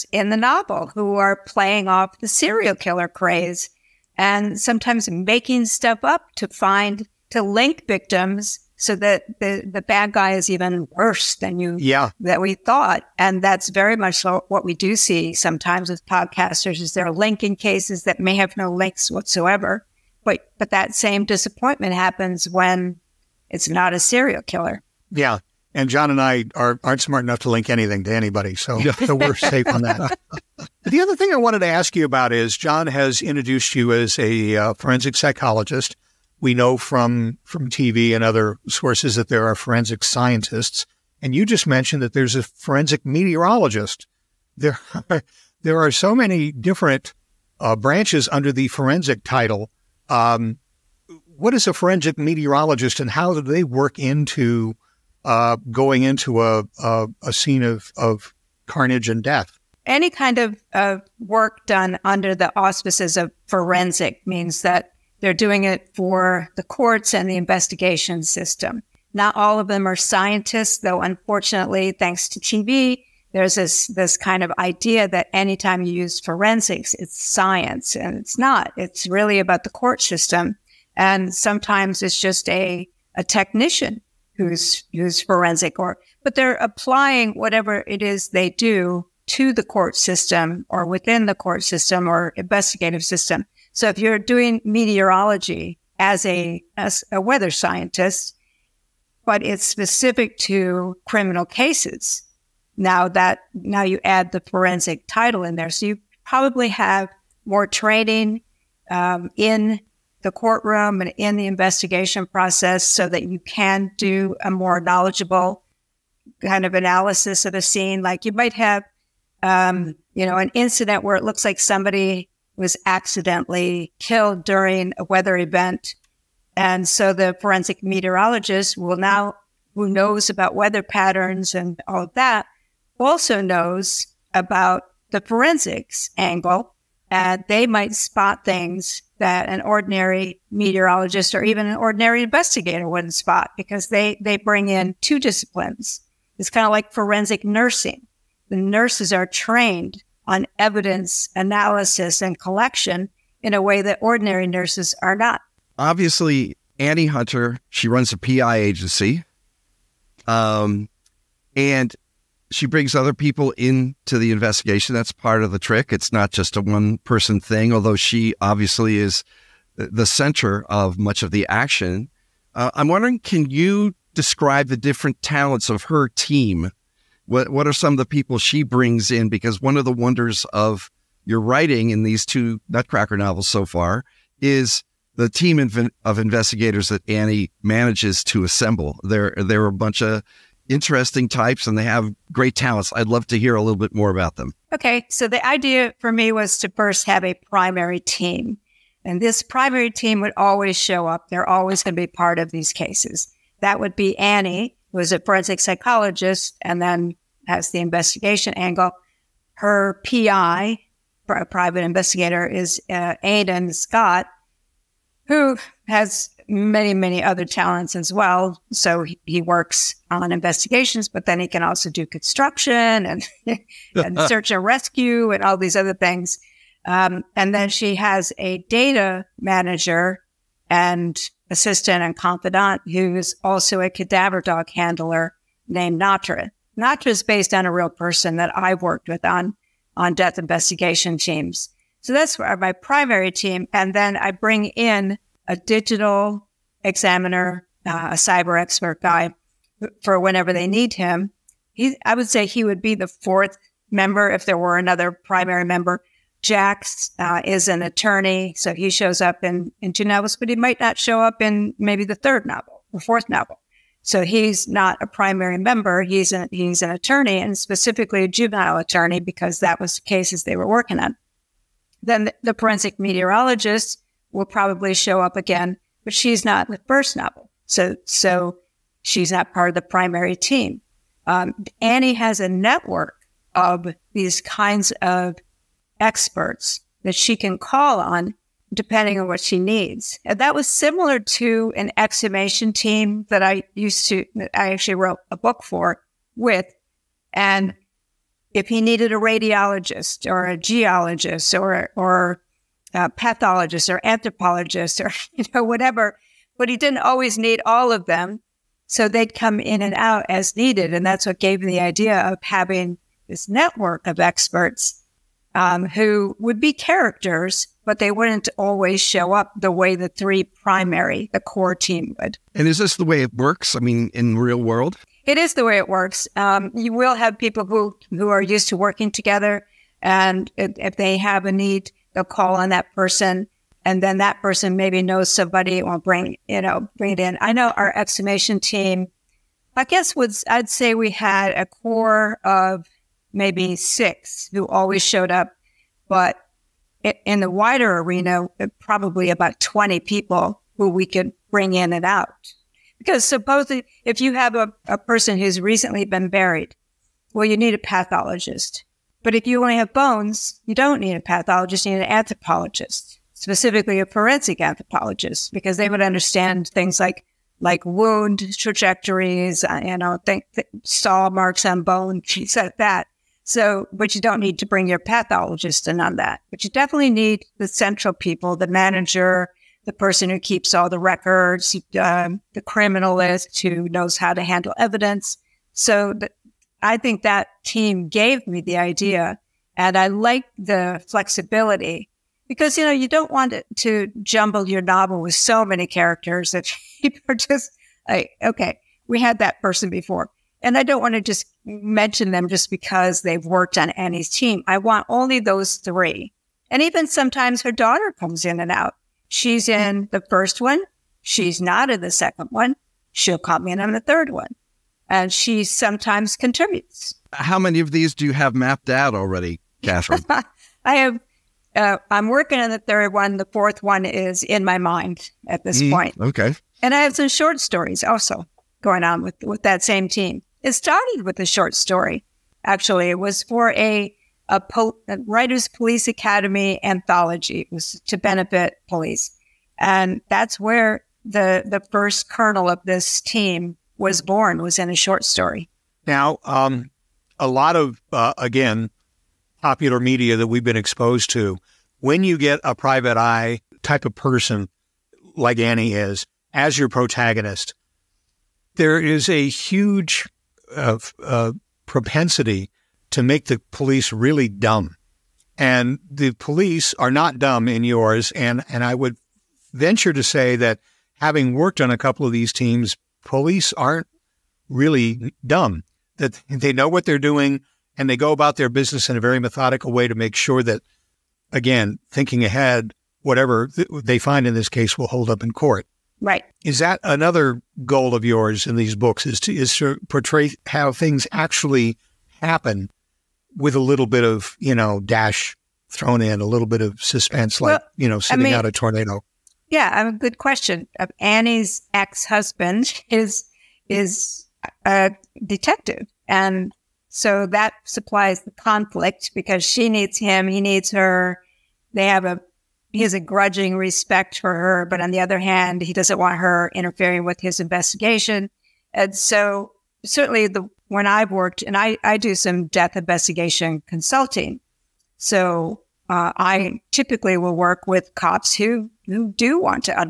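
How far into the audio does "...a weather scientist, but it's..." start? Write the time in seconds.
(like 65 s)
97 s.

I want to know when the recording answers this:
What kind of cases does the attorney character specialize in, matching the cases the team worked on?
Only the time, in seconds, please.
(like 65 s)
268 s.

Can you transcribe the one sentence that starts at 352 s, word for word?
Because supposedly, if you have a, a person who's recently been buried, well, you need a pathologist.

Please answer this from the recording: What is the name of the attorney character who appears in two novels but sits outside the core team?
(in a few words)
Jax.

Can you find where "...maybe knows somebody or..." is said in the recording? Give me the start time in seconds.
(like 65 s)
334 s.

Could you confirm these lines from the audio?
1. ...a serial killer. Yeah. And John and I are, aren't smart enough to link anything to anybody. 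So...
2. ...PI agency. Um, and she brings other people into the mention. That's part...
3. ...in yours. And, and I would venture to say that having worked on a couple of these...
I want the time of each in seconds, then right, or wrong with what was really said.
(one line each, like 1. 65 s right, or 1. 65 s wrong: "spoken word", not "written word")
1. 23 s right
2. 158 s wrong: "investigation", not "mention"
3. 467 s right.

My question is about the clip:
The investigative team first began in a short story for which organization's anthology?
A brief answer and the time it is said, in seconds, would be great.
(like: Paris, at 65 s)
Writers Police Academy, at 435 s.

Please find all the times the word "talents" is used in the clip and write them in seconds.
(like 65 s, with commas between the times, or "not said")
175 s, 192 s, 217 s.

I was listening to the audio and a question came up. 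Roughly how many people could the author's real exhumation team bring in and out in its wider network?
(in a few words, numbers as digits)
20.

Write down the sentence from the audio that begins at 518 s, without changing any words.
And so certainly the when I've worked and I, I do some death investigation consulting.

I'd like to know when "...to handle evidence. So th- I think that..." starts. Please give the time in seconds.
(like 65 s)
384 s.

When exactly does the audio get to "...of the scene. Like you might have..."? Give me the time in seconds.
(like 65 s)
117 s.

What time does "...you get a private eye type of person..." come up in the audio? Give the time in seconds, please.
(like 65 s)
452 s.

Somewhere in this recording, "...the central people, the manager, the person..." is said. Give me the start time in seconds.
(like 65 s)
377 s.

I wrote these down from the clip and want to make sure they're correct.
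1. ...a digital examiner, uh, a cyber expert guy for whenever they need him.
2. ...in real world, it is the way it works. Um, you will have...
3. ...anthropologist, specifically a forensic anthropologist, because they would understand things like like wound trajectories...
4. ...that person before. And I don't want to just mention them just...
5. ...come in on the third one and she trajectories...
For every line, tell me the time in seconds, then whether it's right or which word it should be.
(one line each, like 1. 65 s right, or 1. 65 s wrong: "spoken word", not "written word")
1. 245 s right
2. 324 s right
3. 362 s right
4. 399 s right
5. 413 s wrong: "sometimes", not "trajectories".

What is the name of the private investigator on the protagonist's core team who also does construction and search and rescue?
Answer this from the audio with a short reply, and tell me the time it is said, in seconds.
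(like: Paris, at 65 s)
Aidan Scott, at 213 s.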